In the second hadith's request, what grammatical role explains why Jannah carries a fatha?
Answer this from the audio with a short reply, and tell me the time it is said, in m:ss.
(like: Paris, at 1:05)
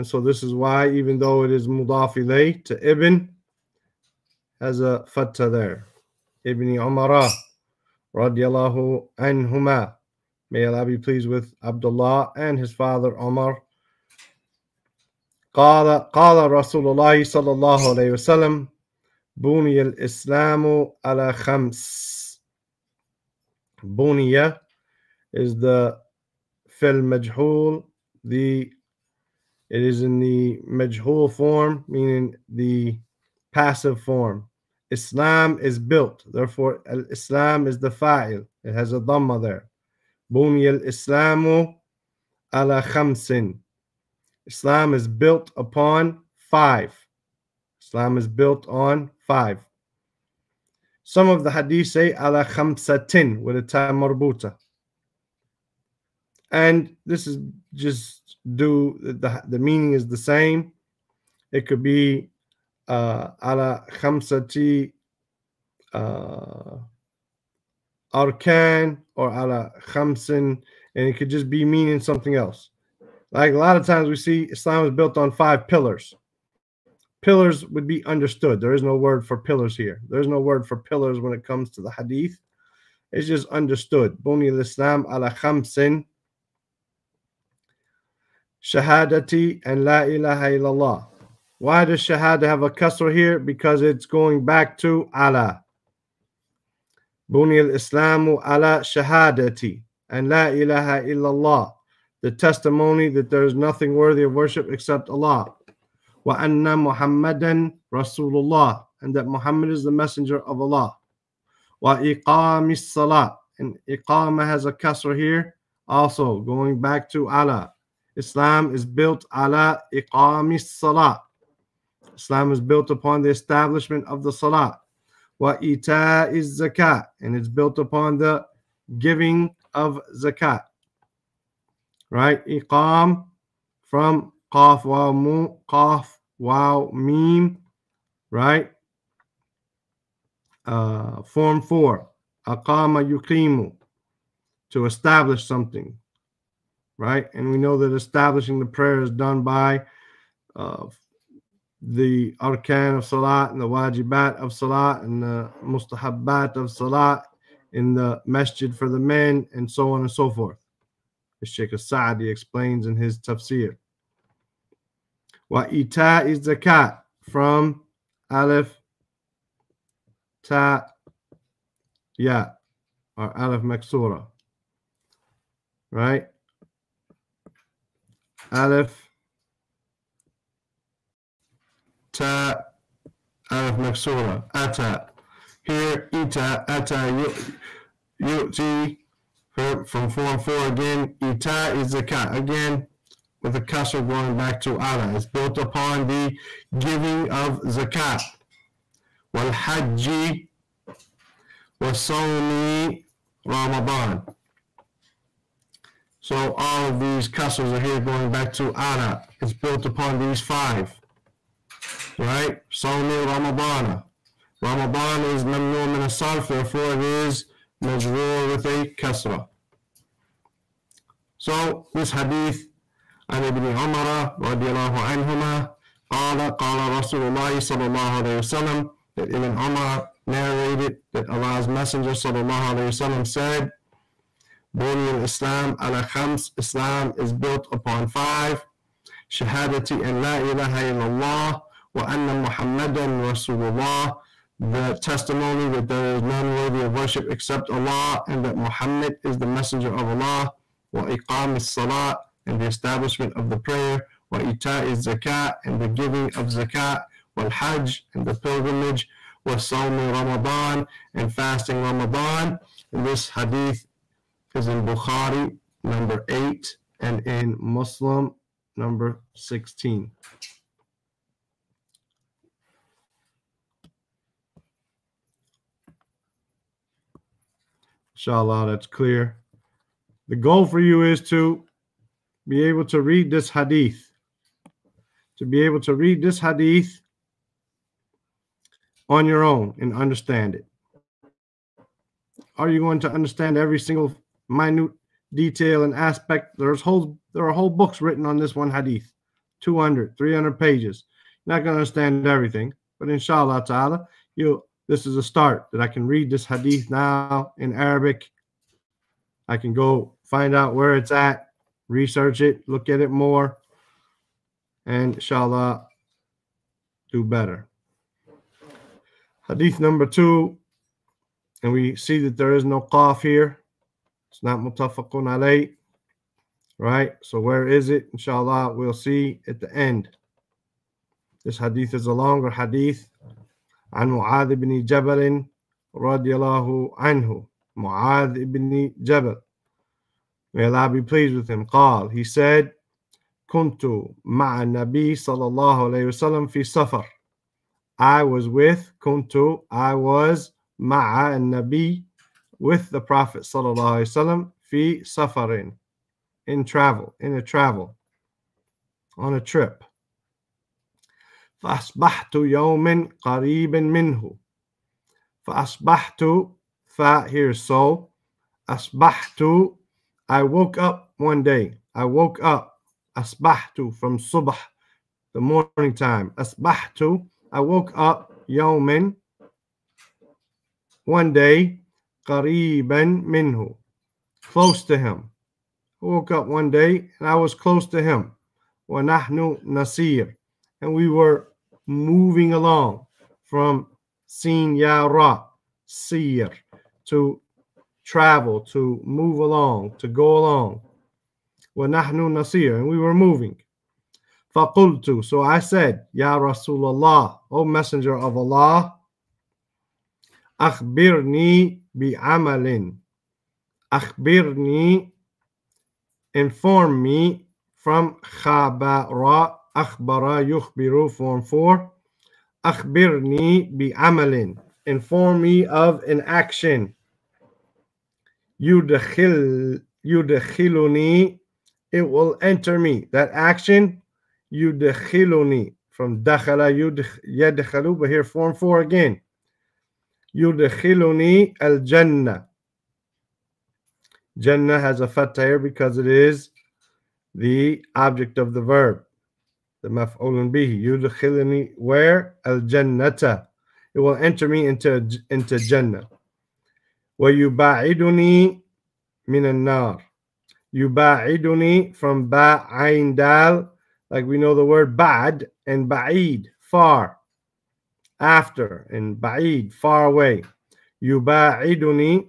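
Object of the verb, at 7:29.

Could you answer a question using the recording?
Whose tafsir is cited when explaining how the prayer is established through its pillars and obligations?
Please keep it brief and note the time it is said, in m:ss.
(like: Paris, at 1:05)
Sheikh Sa'di, at 2:41.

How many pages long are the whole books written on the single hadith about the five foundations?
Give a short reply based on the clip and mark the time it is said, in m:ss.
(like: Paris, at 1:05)
200, 300, at 4:59.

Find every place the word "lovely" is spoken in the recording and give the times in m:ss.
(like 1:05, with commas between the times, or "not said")
not said.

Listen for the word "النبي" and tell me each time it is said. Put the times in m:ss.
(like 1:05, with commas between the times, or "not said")
5:44, 5:51.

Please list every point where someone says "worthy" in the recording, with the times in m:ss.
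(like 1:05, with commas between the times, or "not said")
1:43, 4:06.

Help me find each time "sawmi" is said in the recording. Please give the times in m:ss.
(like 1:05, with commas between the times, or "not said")
3:21, 3:32, 4:19.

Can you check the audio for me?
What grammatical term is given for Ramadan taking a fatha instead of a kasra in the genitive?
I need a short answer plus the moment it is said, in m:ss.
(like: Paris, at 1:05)
mamnu min asarf, at 3:35.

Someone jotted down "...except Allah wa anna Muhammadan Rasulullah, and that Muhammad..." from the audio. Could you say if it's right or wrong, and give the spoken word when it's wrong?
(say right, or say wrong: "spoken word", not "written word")
right.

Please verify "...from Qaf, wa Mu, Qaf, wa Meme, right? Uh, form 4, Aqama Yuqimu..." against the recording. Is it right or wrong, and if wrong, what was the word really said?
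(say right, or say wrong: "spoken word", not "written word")
right.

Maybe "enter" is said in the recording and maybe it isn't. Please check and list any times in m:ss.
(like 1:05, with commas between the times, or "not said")
7:12, 7:34.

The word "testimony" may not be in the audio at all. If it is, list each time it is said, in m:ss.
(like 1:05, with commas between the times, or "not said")
1:42, 4:05.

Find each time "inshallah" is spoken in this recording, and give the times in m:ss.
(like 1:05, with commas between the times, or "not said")
4:38, 5:03, 5:15, 5:28.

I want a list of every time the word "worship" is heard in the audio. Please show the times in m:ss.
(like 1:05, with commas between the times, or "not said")
1:44, 4:06.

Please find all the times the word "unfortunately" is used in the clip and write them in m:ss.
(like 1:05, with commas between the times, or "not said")
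not said.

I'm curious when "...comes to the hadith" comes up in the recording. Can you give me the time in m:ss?
1:21.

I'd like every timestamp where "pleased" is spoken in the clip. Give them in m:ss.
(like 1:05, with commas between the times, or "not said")
0:10, 5:41.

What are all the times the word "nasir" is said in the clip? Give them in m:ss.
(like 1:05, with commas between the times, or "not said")
6:29, 6:42.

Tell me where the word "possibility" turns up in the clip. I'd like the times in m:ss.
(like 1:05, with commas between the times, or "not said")
not said.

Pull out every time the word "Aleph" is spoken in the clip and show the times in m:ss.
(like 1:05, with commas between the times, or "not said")
2:48, 2:53, 2:58, 3:03.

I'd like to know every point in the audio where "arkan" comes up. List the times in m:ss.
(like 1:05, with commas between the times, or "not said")
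1:08, 2:32.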